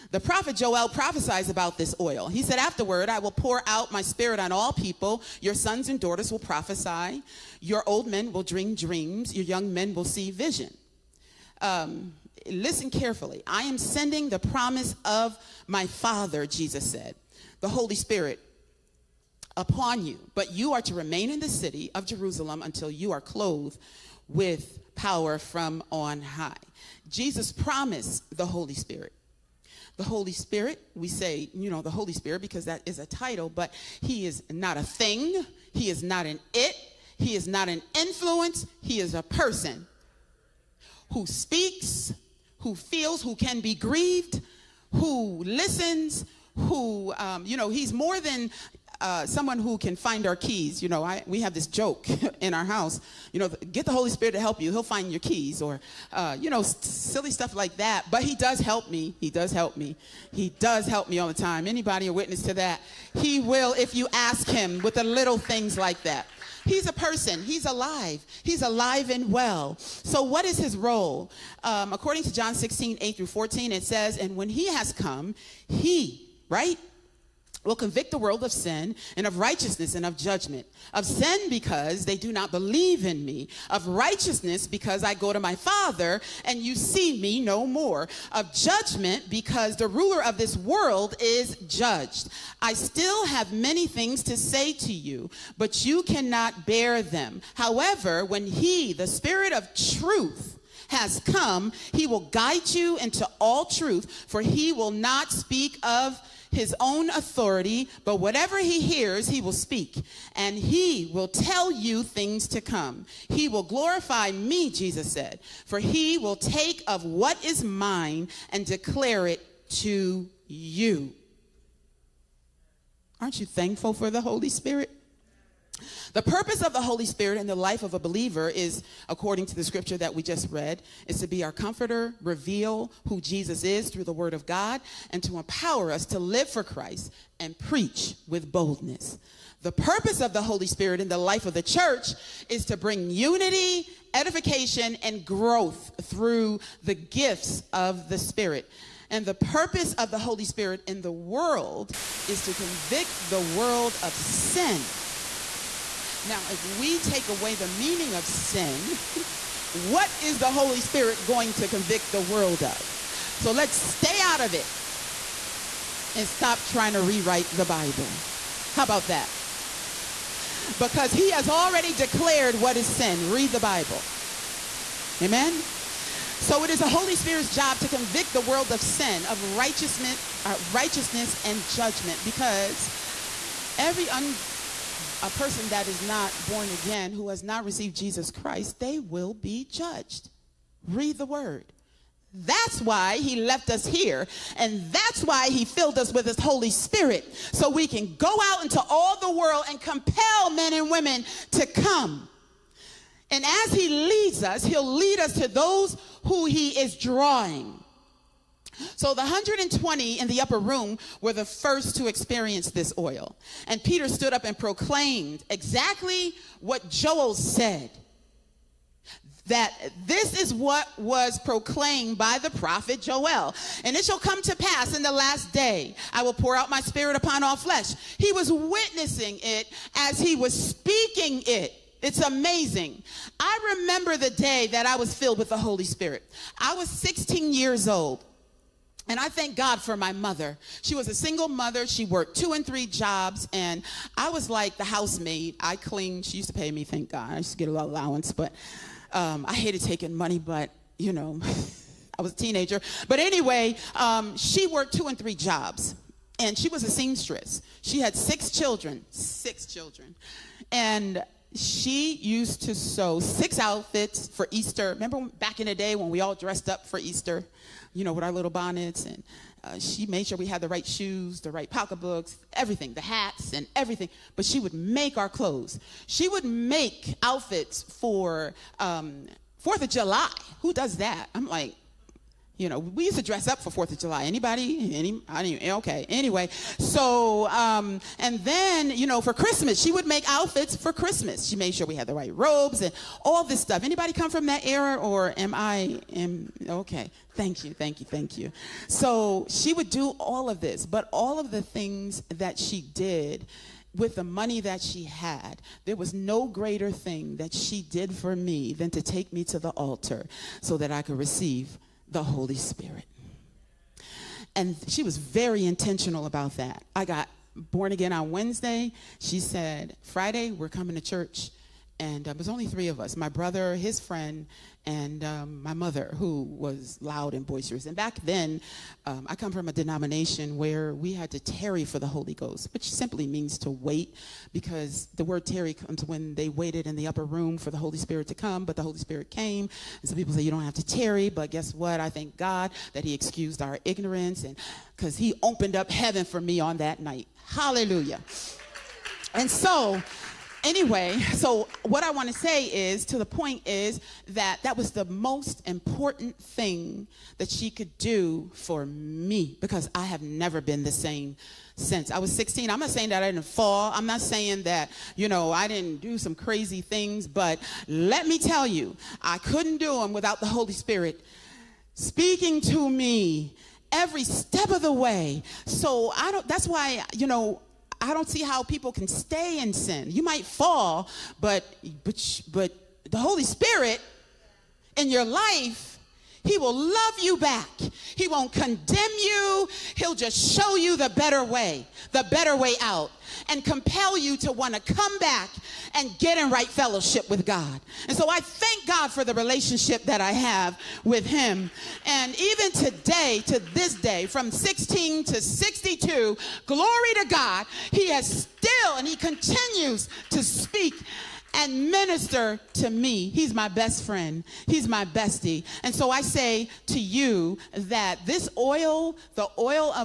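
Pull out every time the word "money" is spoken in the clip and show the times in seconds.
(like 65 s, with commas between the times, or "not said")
250 s, 304 s.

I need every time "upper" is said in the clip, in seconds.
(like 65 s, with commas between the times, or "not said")
210 s, 337 s.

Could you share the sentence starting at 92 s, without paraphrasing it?
I still have many things to say to you, but you cannot bear them.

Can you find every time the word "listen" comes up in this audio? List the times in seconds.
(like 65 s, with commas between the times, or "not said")
12 s, 45 s.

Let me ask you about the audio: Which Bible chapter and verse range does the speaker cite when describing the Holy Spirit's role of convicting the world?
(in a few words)
John 16:8-14.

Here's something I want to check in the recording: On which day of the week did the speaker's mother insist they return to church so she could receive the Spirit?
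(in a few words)
Friday.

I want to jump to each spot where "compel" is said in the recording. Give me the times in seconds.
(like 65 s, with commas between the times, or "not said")
199 s, 393 s.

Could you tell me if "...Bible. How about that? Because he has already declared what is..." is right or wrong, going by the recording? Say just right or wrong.
right.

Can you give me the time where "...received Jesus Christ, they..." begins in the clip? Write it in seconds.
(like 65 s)
187 s.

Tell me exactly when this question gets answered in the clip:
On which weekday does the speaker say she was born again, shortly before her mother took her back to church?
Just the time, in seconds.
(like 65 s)
318 s.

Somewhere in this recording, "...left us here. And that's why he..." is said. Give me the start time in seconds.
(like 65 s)
193 s.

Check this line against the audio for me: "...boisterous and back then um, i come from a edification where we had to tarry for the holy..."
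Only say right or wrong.
wrong.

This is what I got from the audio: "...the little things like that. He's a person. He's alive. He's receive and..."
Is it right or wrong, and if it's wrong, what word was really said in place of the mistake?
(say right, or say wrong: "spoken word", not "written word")
wrong: "alive", not "receive".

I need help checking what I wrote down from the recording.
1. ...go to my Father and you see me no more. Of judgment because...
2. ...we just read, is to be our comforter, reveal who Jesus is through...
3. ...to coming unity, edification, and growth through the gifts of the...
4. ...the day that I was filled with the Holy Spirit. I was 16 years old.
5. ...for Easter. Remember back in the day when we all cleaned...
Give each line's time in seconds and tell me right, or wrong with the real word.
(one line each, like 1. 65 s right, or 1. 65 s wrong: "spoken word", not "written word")
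1. 85 s right
2. 130 s right
3. 142 s wrong: "bring", not "coming"
4. 234 s right
5. 264 s wrong: "dressed", not "cleaned".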